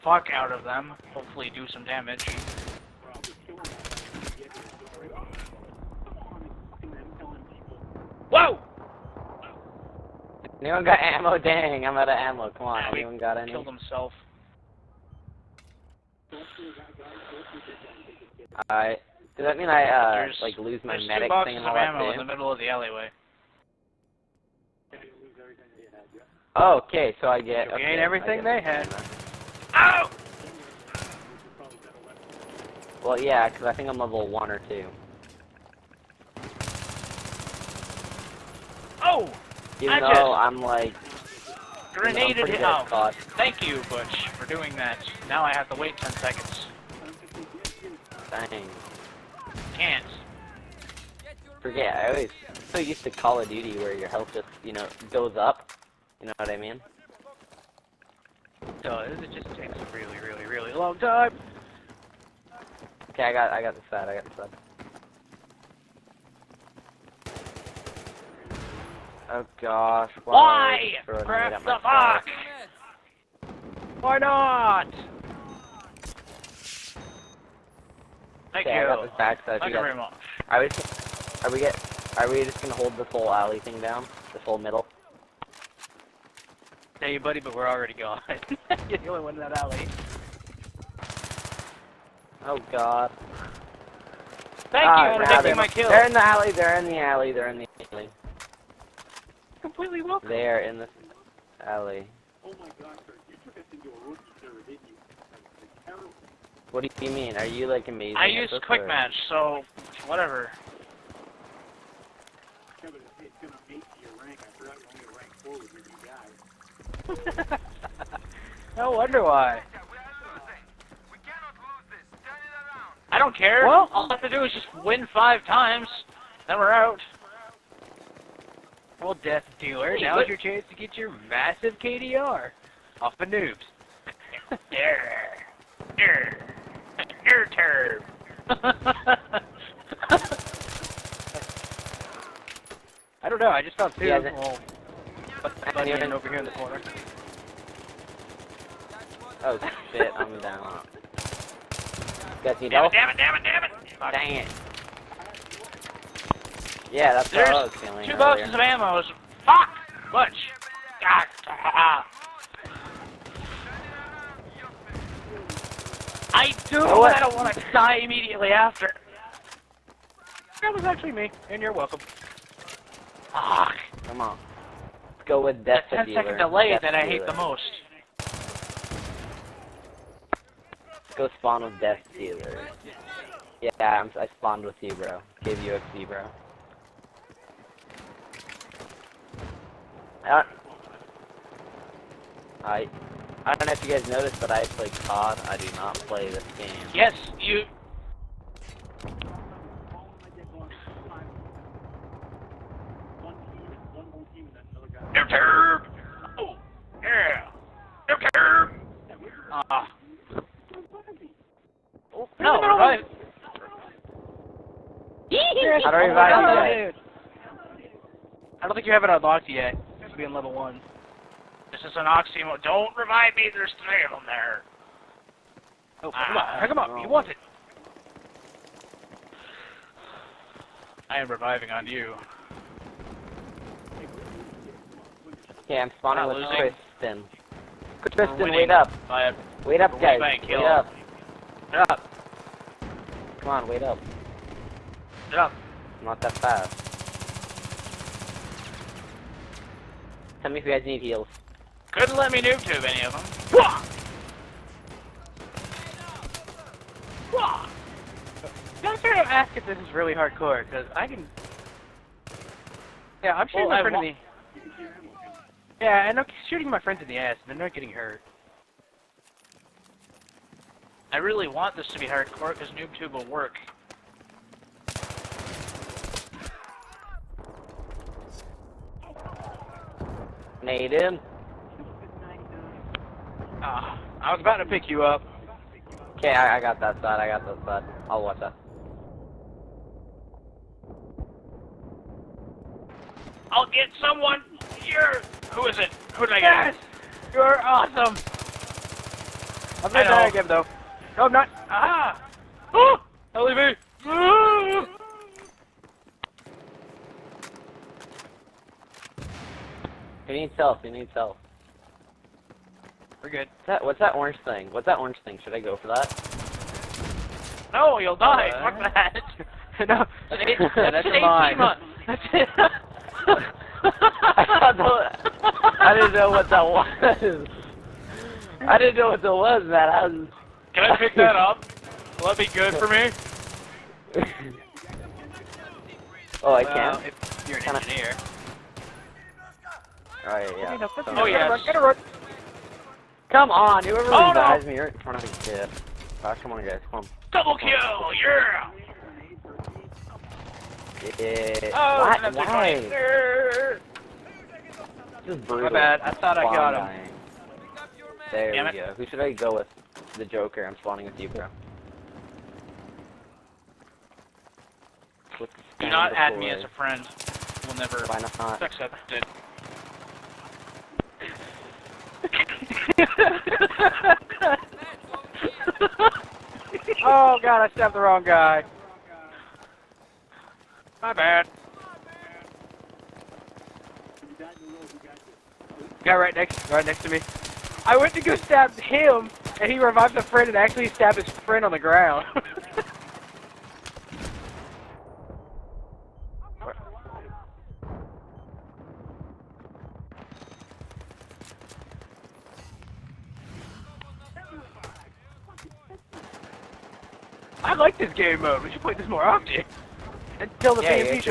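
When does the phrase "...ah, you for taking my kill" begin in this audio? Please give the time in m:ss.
1:34.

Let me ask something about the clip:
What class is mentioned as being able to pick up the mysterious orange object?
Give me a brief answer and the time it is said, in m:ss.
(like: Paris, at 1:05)
engineer, at 5:37.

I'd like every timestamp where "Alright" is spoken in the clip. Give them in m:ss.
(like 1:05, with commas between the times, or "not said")
0:18.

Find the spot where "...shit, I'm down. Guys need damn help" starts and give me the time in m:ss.
2:29.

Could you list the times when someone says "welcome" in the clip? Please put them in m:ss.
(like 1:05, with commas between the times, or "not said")
1:40, 2:51.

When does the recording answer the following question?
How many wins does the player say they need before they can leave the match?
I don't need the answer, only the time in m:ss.
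2:05.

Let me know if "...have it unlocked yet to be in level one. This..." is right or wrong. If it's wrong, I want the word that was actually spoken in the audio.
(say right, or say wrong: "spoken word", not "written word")
right.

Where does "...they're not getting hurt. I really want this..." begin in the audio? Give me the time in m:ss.
4:27.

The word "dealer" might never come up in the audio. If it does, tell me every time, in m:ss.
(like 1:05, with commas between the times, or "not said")
2:09, 3:02.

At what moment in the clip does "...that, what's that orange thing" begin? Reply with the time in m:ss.
5:13.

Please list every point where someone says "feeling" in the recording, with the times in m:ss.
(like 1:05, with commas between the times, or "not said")
2:37.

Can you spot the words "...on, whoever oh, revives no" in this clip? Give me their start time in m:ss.
5:43.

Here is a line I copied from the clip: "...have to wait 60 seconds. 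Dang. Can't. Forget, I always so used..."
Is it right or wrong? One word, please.
wrong.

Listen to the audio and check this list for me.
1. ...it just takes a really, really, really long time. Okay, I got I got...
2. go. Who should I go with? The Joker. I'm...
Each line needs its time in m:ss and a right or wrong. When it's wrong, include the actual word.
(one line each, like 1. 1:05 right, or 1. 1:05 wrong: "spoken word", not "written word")
1. 0:59 right
2. 5:58 right.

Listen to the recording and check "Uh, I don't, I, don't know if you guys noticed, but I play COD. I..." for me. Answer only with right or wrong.
right.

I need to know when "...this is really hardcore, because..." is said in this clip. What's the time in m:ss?
4:19.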